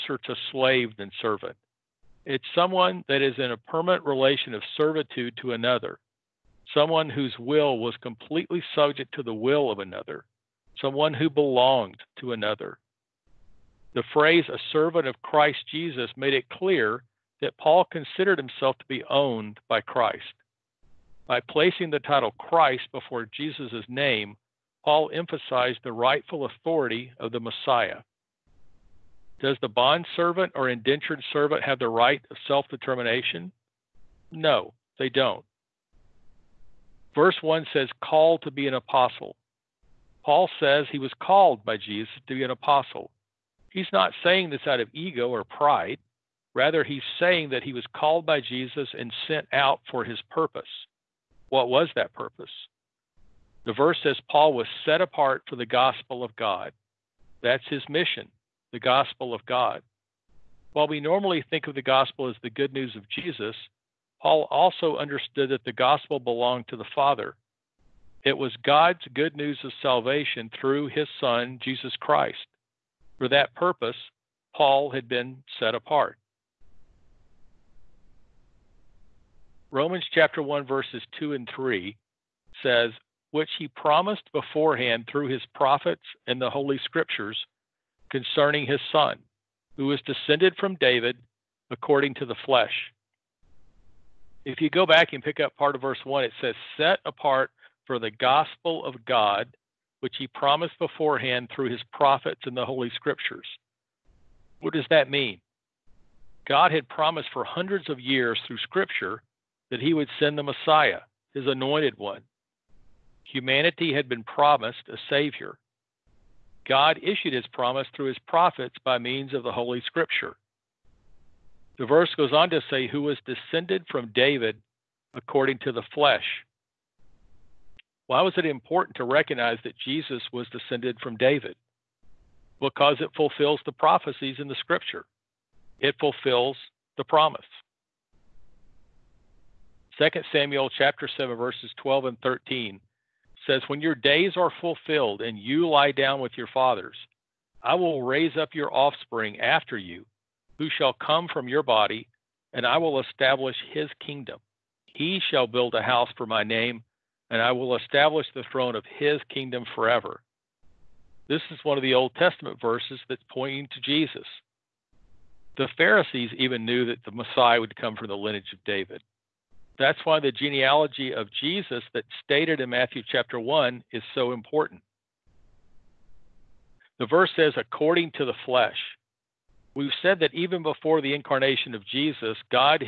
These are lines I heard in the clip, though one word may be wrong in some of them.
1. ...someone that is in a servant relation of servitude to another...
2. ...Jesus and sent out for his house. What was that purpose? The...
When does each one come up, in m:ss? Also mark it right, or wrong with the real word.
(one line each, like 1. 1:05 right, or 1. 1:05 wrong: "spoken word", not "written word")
1. 0:02 wrong: "permanent", not "servant"
2. 0:48 wrong: "purpose", not "house".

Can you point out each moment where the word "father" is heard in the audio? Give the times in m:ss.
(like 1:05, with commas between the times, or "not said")
1:06, 2:26.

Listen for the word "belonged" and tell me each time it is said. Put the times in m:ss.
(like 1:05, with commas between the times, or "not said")
0:11, 1:06.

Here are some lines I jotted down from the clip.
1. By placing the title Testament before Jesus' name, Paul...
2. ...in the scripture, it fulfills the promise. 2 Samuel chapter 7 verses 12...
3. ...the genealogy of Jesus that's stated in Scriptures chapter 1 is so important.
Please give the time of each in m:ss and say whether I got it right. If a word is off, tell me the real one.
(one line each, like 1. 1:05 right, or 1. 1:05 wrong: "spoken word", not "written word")
1. 0:21 wrong: "Christ", not "Testament"
2. 2:14 right
3. 2:50 wrong: "Matthew", not "Scriptures".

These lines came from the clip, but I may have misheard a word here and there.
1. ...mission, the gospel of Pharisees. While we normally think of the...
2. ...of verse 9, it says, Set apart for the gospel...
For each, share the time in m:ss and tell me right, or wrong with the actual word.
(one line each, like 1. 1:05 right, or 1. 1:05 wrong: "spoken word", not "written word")
1. 0:57 wrong: "God", not "Pharisees"
2. 1:35 wrong: "1", not "9".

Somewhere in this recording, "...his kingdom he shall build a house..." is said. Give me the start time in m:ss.
2:33.